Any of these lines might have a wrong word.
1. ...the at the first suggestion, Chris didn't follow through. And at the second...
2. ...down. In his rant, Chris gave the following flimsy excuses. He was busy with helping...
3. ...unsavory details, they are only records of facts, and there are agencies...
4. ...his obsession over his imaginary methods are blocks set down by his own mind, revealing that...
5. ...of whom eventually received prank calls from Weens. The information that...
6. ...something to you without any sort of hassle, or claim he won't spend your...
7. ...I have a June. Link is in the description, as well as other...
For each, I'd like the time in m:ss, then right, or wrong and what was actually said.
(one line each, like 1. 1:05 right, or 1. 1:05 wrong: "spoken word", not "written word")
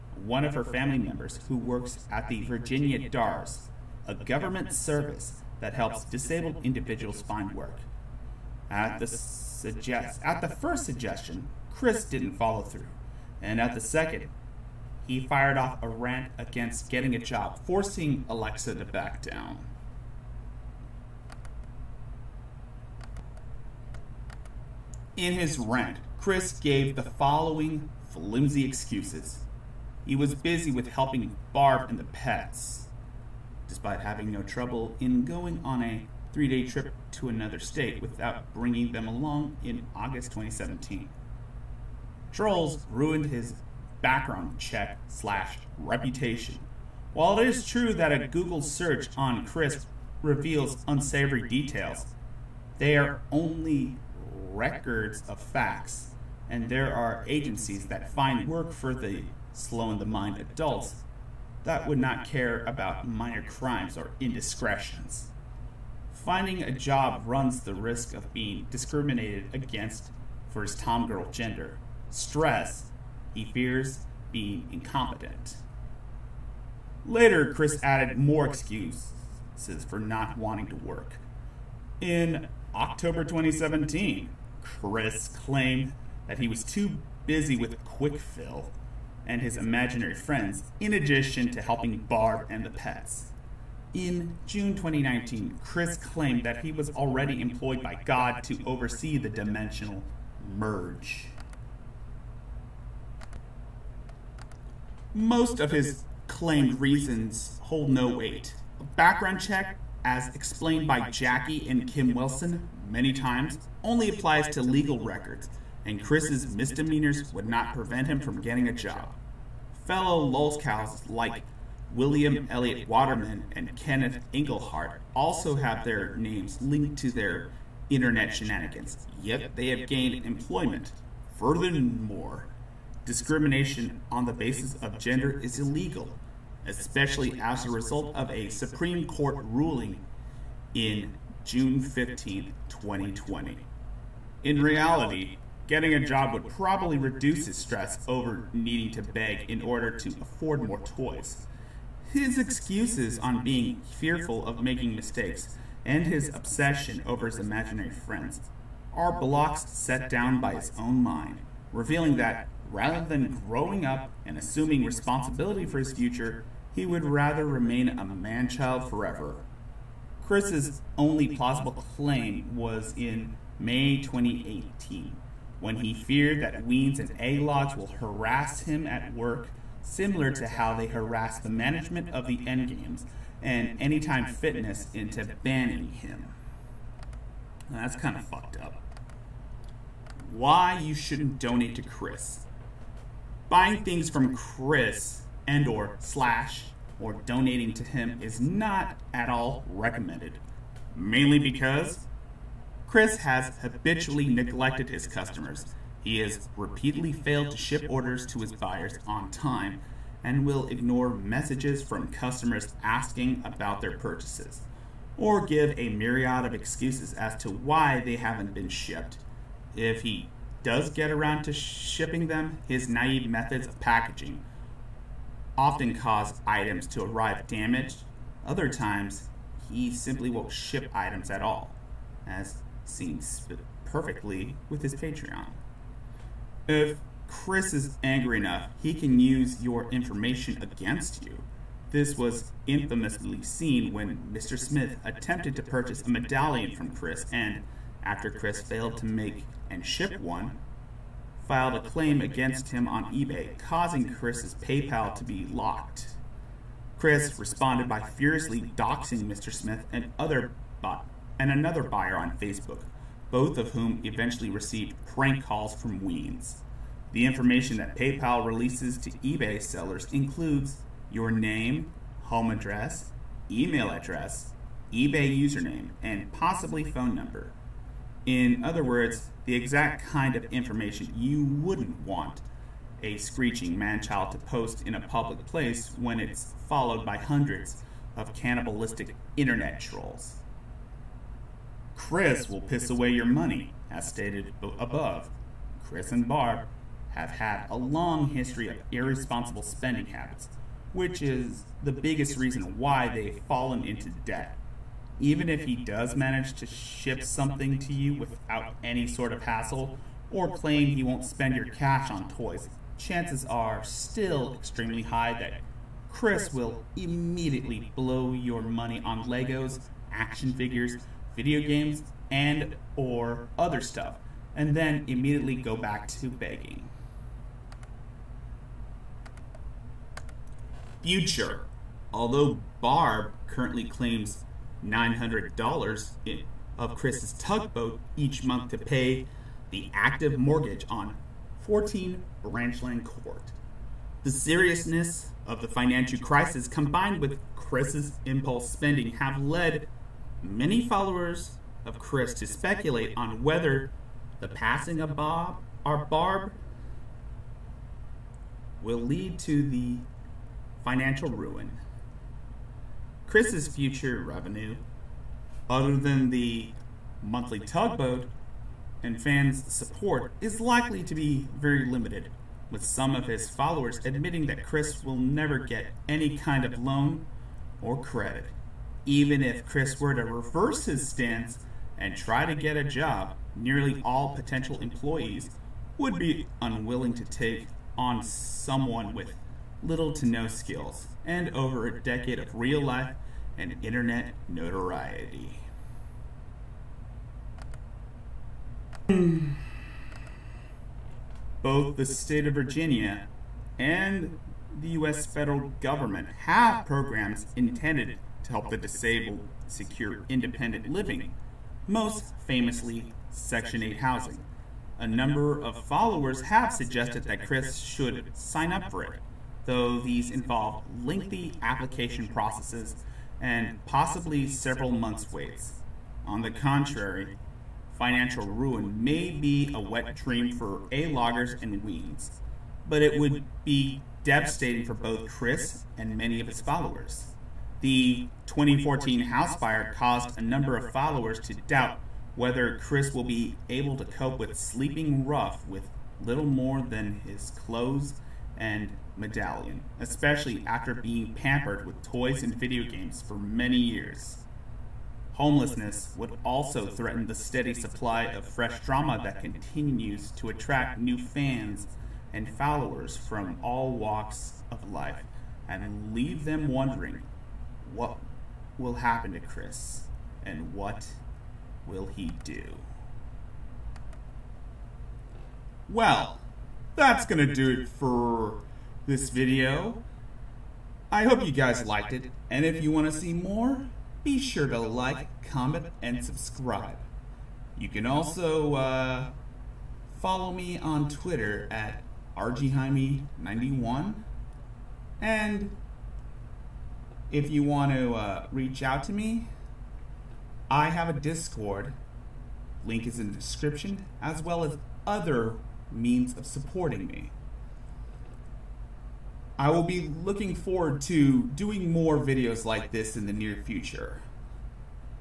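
1. 0:08 right
2. 0:19 right
3. 0:50 right
4. 2:36 wrong: "friends", not "methods"
5. 4:23 right
6. 5:07 right
7. 8:20 wrong: "Discord", not "June".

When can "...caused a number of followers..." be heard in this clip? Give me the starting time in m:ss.
7:19.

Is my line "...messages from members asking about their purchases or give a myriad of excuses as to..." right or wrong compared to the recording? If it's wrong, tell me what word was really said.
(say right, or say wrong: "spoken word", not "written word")
wrong: "customers", not "members".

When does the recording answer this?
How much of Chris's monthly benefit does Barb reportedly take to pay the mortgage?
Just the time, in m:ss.
5:34.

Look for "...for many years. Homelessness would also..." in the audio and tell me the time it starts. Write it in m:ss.
7:33.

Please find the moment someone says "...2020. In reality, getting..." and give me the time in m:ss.
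2:22.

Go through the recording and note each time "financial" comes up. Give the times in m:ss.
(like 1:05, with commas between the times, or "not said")
5:45, 6:00, 7:07.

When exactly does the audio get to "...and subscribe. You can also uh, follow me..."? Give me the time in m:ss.
8:06.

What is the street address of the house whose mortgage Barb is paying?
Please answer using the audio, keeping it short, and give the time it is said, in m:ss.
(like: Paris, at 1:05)
14 Branchland Court, at 5:41.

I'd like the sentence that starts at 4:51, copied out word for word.
Chris will piss away your money, as stated above.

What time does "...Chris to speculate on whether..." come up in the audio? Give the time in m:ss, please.
5:51.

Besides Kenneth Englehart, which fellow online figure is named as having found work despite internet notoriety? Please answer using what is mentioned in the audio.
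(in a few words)
William Elliott Waterman.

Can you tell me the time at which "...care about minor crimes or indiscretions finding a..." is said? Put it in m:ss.
1:02.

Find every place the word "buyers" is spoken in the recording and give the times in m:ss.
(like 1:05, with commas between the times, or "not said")
3:28, 4:21.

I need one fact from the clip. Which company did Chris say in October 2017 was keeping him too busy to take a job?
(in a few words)
Quick Fill.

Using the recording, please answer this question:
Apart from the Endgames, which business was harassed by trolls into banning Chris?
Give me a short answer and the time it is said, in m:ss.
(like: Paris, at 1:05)
Anytime Fitness, at 3:03.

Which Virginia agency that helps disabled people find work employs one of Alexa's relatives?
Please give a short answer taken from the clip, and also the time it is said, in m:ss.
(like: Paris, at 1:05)
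Virginia DARS, at 0:02.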